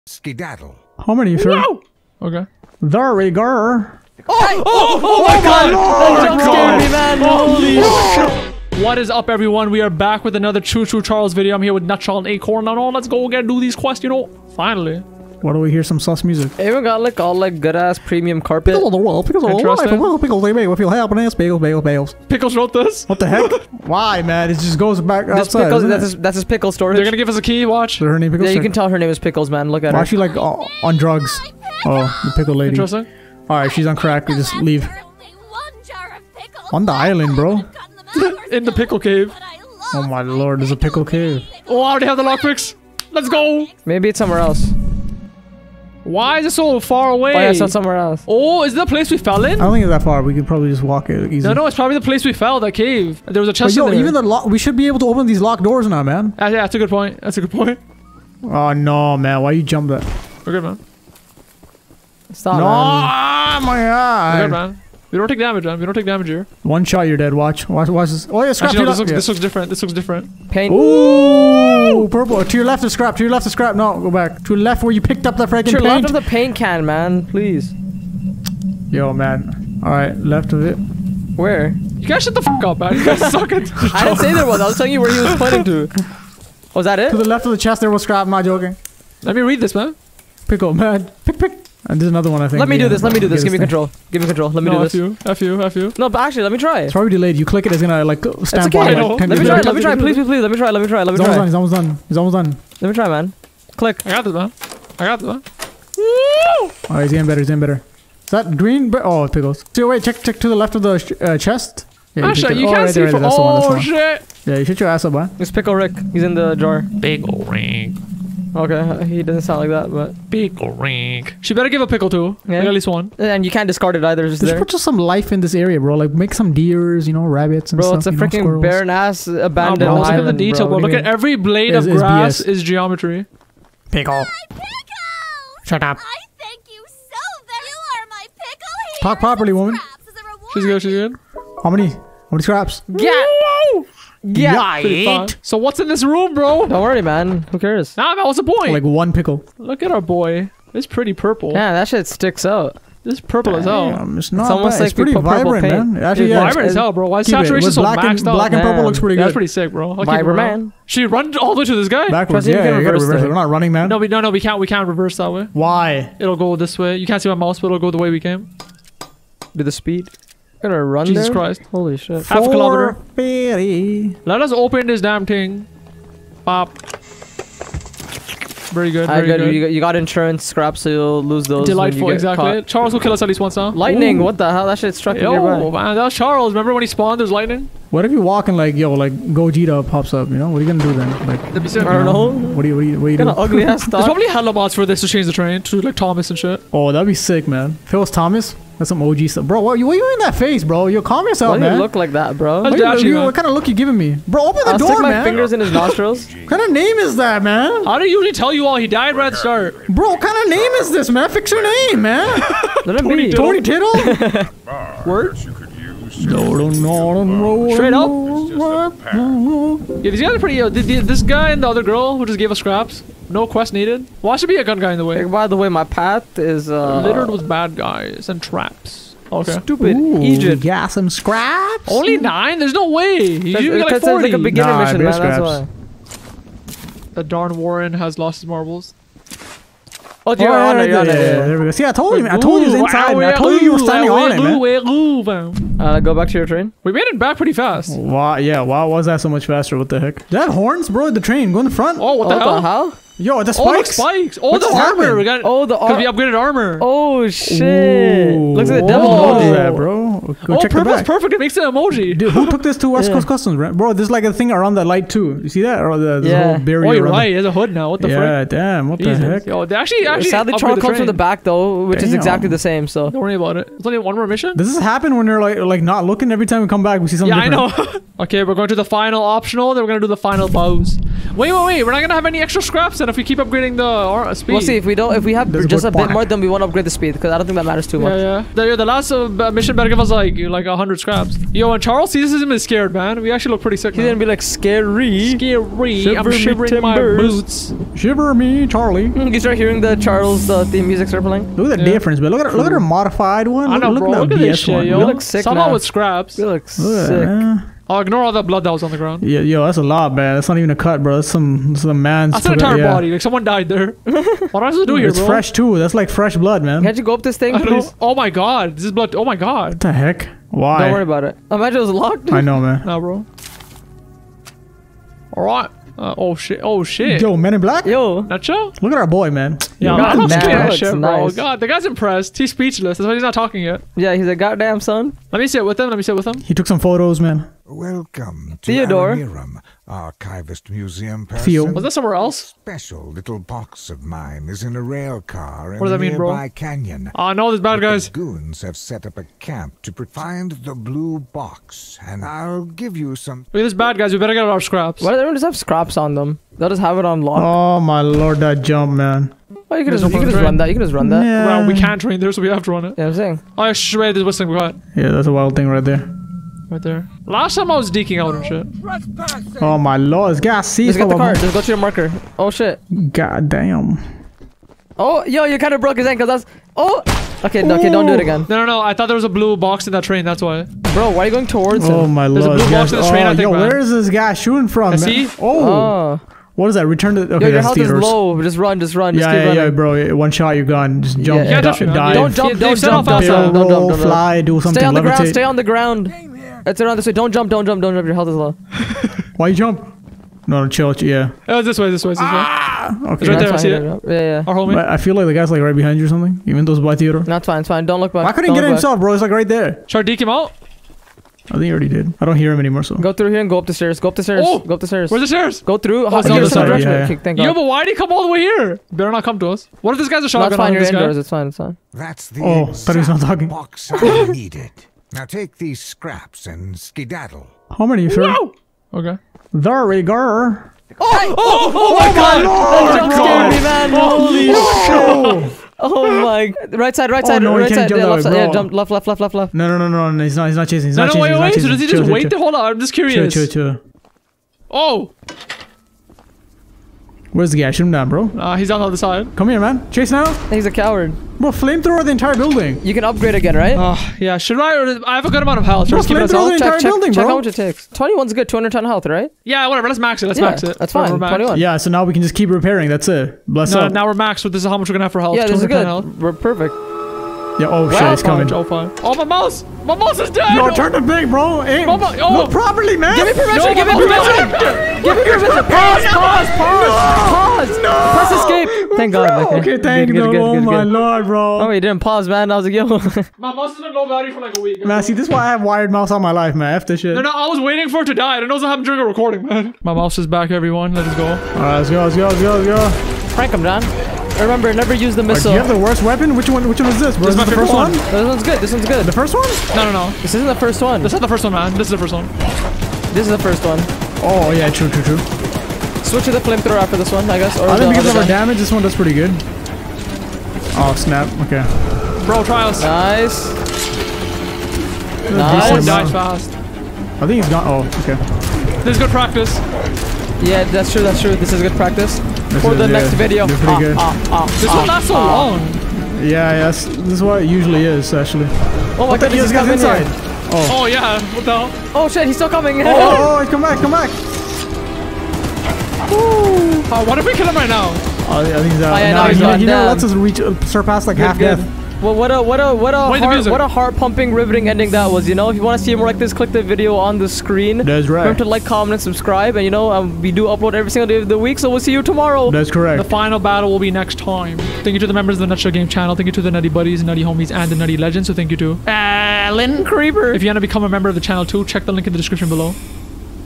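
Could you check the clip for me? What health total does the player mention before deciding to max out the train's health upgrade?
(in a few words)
210.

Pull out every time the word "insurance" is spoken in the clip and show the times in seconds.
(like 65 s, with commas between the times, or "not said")
179 s.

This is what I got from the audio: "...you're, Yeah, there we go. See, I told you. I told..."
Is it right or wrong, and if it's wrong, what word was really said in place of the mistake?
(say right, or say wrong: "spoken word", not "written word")
right.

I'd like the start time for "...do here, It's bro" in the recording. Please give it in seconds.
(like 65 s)
314 s.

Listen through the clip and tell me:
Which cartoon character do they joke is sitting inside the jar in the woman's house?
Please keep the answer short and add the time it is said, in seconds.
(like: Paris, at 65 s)
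Pickle Rick, at 115 s.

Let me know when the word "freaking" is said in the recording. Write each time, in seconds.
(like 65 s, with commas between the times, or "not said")
75 s, 128 s.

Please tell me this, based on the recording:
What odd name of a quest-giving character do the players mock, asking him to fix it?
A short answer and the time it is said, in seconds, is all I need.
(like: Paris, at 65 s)
Tony Tittle, at 212 s.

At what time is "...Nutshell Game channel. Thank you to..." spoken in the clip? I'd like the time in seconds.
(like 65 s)
555 s.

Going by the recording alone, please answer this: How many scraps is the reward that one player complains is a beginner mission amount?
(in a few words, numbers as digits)
9.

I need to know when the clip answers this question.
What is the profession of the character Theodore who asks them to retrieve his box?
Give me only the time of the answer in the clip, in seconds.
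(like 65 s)
339 s.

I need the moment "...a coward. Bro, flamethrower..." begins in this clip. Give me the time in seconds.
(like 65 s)
450 s.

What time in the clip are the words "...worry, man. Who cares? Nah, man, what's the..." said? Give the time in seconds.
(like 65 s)
146 s.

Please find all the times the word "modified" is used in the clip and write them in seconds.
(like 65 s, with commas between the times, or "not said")
302 s.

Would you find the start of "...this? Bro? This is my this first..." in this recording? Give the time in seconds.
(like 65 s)
496 s.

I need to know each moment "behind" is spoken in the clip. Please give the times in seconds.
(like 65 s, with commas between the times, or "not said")
405 s.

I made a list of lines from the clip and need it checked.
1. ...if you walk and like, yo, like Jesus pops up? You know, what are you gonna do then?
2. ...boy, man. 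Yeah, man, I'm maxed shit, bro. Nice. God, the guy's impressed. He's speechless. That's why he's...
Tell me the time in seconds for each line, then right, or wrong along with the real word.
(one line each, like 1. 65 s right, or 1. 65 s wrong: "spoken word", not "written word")
1. 188 s wrong: "Gogeta", not "Jesus"
2. 329 s wrong: "scared", not "maxed".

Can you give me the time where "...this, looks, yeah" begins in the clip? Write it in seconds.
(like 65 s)
68 s.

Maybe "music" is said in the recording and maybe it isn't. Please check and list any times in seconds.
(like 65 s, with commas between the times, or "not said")
16 s, 300 s.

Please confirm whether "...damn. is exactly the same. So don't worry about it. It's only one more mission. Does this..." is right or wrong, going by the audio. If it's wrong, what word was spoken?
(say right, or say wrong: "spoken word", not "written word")
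right.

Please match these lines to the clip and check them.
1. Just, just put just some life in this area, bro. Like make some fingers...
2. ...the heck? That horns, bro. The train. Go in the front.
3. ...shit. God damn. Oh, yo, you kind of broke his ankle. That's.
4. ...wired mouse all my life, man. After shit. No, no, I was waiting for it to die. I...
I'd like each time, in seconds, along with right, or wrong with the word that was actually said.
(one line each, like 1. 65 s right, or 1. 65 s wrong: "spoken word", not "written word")
1. 124 s wrong: "deers", not "fingers"
2. 249 s right
3. 372 s right
4. 485 s right.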